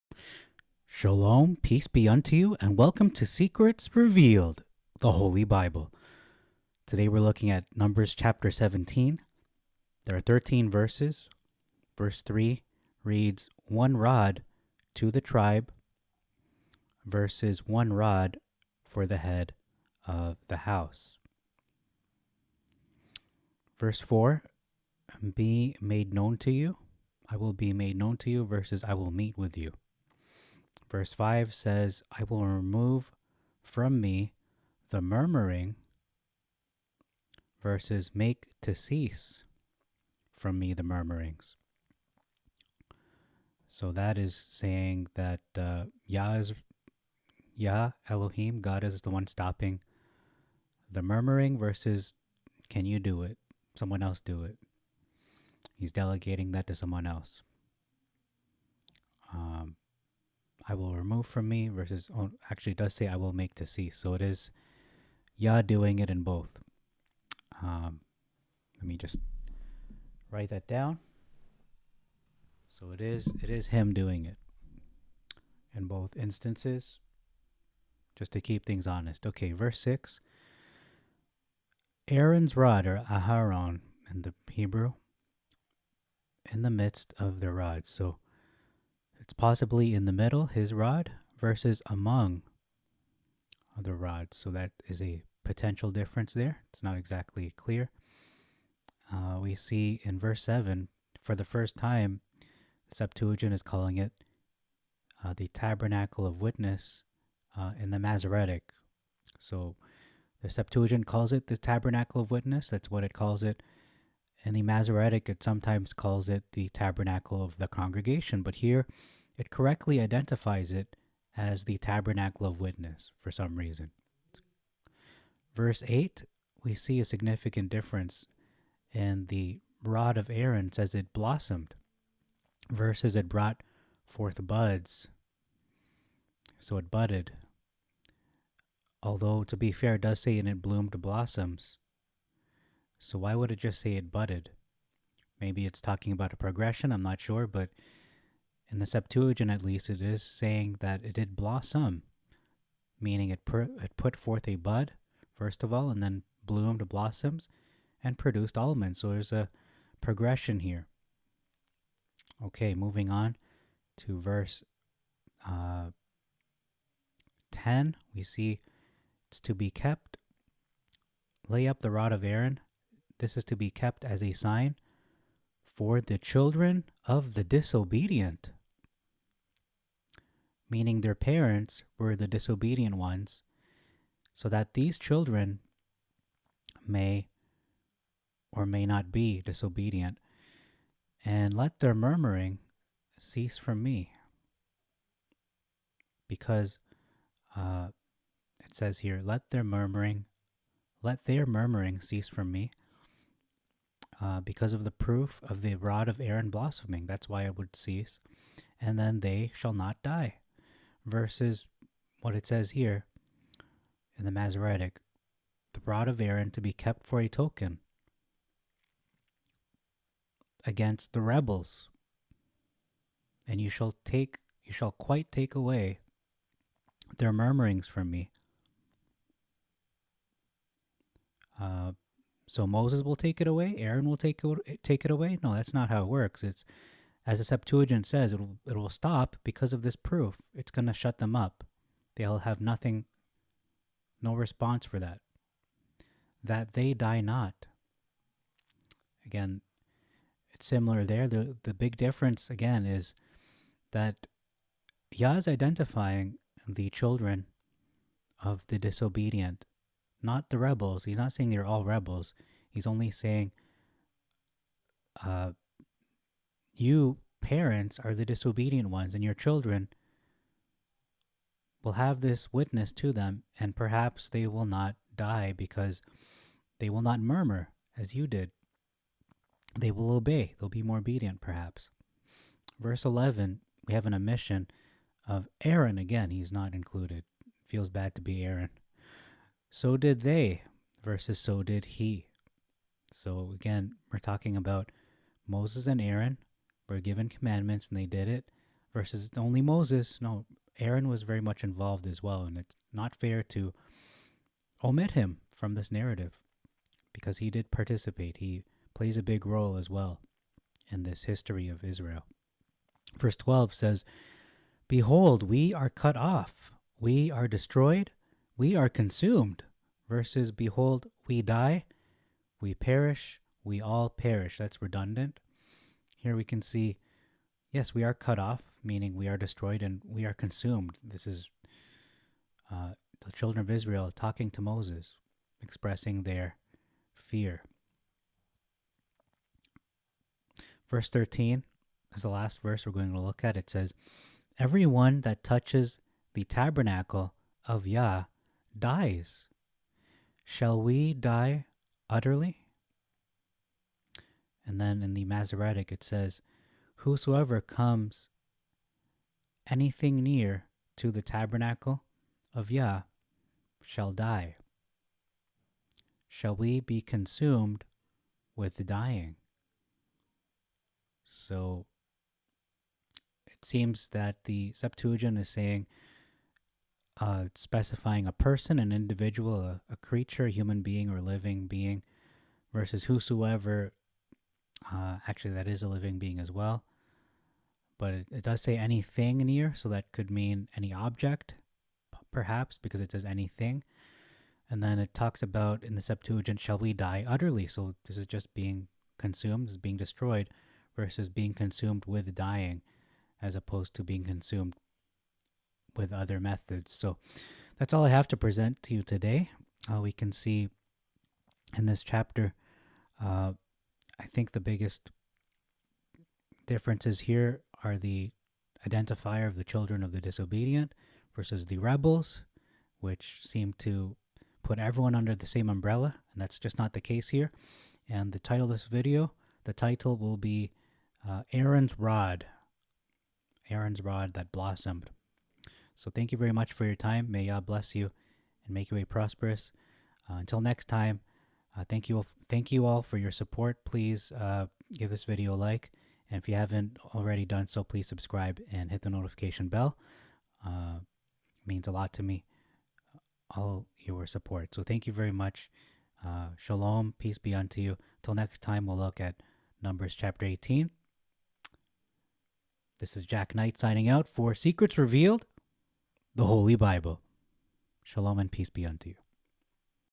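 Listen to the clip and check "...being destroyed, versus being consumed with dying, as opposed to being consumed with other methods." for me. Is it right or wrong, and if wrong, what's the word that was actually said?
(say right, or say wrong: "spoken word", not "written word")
right.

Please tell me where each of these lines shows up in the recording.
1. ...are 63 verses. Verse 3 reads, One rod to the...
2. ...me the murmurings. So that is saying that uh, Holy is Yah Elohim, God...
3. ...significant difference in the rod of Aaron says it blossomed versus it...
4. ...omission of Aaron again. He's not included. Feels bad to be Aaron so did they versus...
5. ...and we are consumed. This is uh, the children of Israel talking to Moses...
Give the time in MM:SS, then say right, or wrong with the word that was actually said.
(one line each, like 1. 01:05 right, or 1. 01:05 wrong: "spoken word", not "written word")
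1. 00:10 wrong: "13", not "63"
2. 00:40 wrong: "Yah", not "Holy"
3. 02:07 right
4. 04:44 right
5. 05:29 right.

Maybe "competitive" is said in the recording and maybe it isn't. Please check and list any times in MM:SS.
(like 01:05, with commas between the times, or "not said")
not said.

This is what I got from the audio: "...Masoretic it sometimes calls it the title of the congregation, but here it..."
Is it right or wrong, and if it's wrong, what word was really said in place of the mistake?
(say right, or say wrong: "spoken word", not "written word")
wrong: "tabernacle", not "title".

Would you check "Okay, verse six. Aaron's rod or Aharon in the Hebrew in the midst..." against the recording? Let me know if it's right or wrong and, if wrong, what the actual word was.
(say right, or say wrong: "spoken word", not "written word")
right.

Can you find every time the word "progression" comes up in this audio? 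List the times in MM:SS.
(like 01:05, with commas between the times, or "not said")
02:26, 02:39.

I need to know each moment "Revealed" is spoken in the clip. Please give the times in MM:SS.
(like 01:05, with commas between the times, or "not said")
00:03, 07:44.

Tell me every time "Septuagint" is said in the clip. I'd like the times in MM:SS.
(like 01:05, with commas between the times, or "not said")
01:42, 01:50, 02:28, 03:57, 06:14, 06:36.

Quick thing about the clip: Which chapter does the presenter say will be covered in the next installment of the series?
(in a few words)
Numbers chapter 18.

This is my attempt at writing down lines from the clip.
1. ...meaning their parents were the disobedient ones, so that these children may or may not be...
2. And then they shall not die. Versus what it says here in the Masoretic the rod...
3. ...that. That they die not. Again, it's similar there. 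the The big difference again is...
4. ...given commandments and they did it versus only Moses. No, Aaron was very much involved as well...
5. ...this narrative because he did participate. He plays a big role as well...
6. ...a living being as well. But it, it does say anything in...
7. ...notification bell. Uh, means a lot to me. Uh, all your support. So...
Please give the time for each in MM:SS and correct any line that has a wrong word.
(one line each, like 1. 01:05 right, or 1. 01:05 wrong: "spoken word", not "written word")
1. 03:00 right
2. 03:28 right
3. 04:04 right
4. 04:56 right
5. 05:05 right
6. 06:25 right
7. 07:29 right.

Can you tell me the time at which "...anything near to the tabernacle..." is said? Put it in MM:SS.
05:59.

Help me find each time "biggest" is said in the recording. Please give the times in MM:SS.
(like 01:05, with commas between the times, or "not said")
06:54.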